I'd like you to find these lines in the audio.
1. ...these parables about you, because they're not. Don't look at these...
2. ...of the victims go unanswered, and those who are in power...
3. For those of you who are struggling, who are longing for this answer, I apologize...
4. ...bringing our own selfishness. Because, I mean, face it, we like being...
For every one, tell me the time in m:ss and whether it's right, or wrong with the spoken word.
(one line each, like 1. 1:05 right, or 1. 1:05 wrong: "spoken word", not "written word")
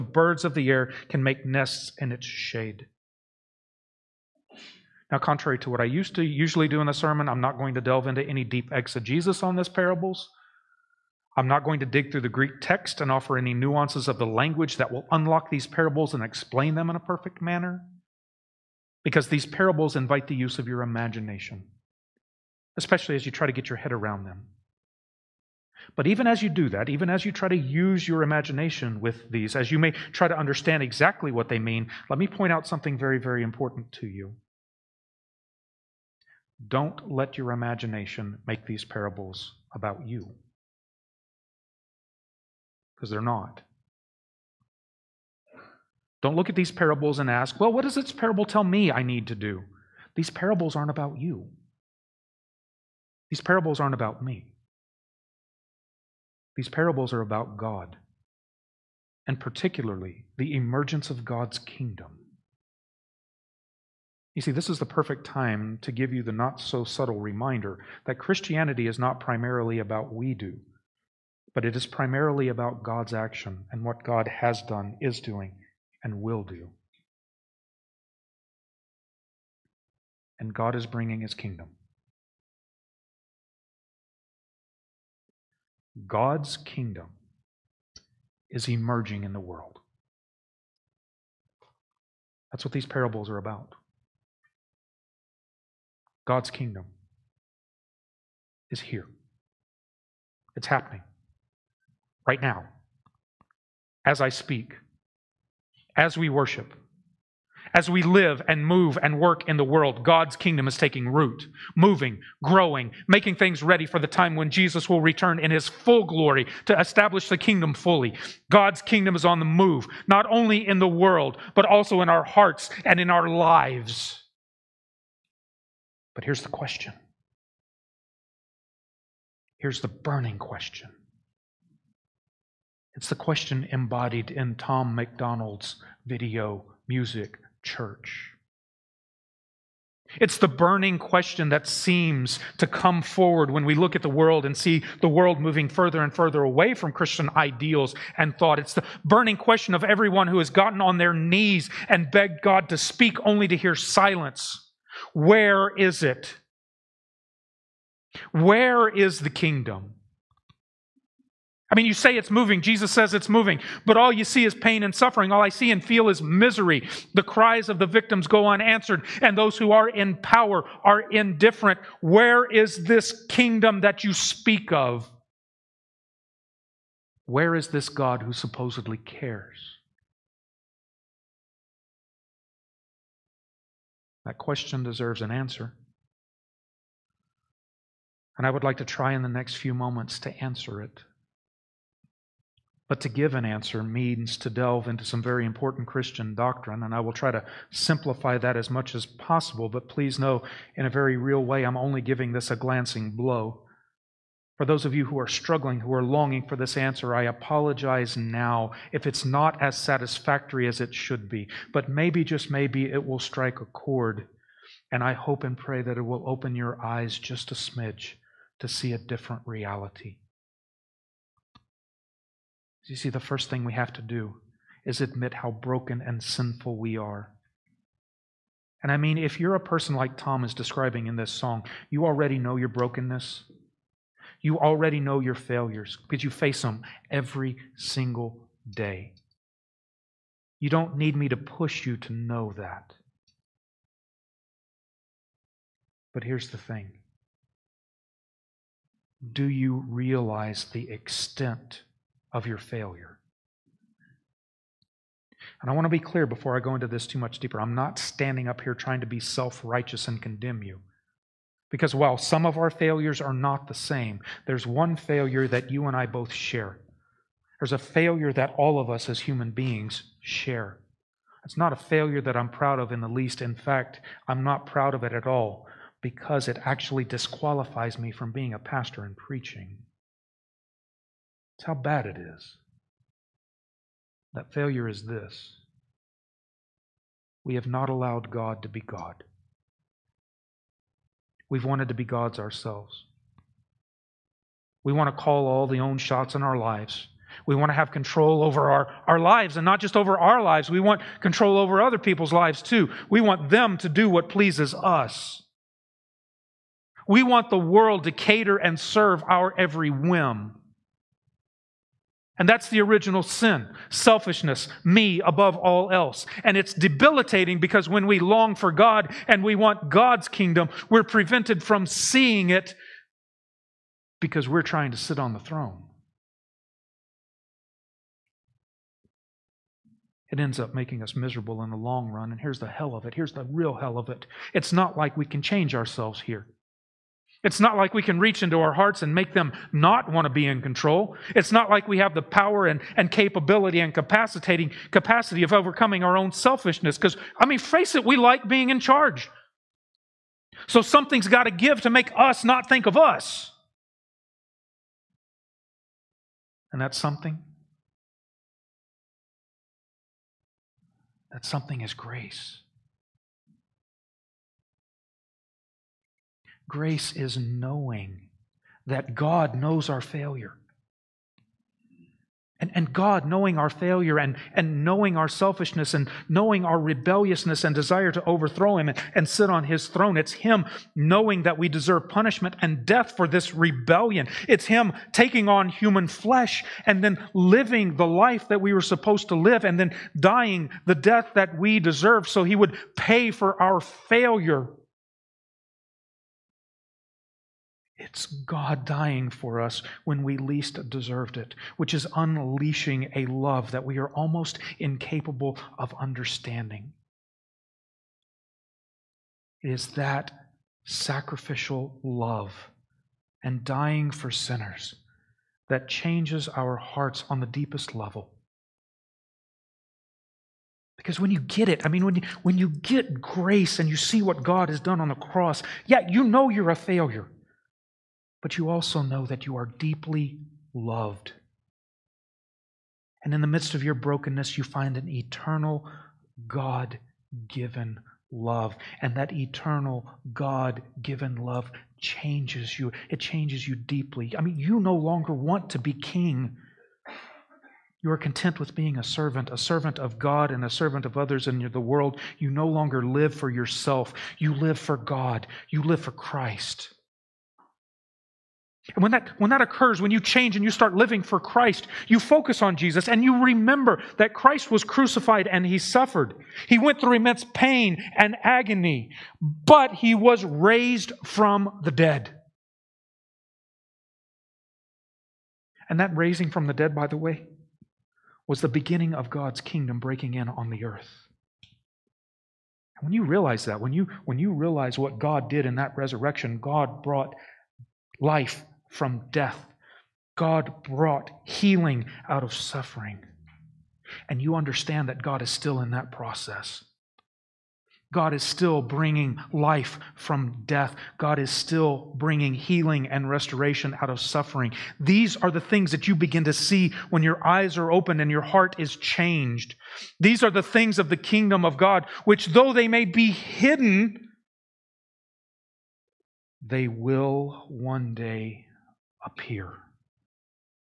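1. 0:38 right
2. 2:47 right
3. 3:24 right
4. 5:45 wrong: "overcoming", not "bringing".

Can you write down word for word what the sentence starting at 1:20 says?
And God is bringing his kingdom.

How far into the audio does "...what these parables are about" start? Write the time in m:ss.
1:32.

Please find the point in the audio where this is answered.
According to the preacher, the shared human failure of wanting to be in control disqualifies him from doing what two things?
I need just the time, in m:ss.
4:38.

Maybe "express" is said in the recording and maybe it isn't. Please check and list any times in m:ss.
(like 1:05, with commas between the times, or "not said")
not said.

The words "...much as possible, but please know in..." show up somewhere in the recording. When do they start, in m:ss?
3:18.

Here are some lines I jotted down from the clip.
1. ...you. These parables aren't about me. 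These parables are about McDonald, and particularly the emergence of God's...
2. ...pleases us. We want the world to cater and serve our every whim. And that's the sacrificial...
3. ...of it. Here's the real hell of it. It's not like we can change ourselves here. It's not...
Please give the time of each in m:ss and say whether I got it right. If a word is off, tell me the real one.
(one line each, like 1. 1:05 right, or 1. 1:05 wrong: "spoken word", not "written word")
1. 0:51 wrong: "God", not "McDonald"
2. 5:04 wrong: "original", not "sacrificial"
3. 5:32 right.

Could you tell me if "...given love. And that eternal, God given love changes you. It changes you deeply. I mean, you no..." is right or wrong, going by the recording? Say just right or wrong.
right.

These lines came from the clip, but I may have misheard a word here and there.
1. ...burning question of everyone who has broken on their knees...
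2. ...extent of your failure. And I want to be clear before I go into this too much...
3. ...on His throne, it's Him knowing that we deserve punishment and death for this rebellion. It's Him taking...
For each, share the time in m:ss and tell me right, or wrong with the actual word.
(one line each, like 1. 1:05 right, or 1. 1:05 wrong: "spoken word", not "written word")
1. 2:29 wrong: "gotten", not "broken"
2. 4:10 right
3. 6:19 right.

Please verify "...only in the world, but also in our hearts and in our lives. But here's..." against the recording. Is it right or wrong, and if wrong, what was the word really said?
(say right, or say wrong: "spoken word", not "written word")
right.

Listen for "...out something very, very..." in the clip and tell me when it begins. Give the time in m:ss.
0:32.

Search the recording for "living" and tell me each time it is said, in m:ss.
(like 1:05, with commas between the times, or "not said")
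6:27, 7:40.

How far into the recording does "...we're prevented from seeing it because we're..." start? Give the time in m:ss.
5:20.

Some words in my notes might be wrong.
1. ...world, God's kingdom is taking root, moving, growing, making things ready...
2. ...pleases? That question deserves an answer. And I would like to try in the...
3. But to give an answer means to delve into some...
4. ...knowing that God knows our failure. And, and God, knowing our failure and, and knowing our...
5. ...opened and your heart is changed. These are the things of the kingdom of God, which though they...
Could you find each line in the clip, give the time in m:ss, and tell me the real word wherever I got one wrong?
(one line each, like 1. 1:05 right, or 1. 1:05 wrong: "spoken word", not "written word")
1. 1:49 right
2. 2:58 wrong: "cares", not "pleases"
3. 3:12 right
4. 6:07 right
5. 8:27 right.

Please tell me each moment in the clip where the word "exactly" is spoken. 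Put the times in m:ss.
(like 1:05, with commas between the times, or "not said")
0:30.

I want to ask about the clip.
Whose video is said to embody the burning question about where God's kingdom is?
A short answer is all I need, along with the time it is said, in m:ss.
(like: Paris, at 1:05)
Tom McDonald, at 2:14.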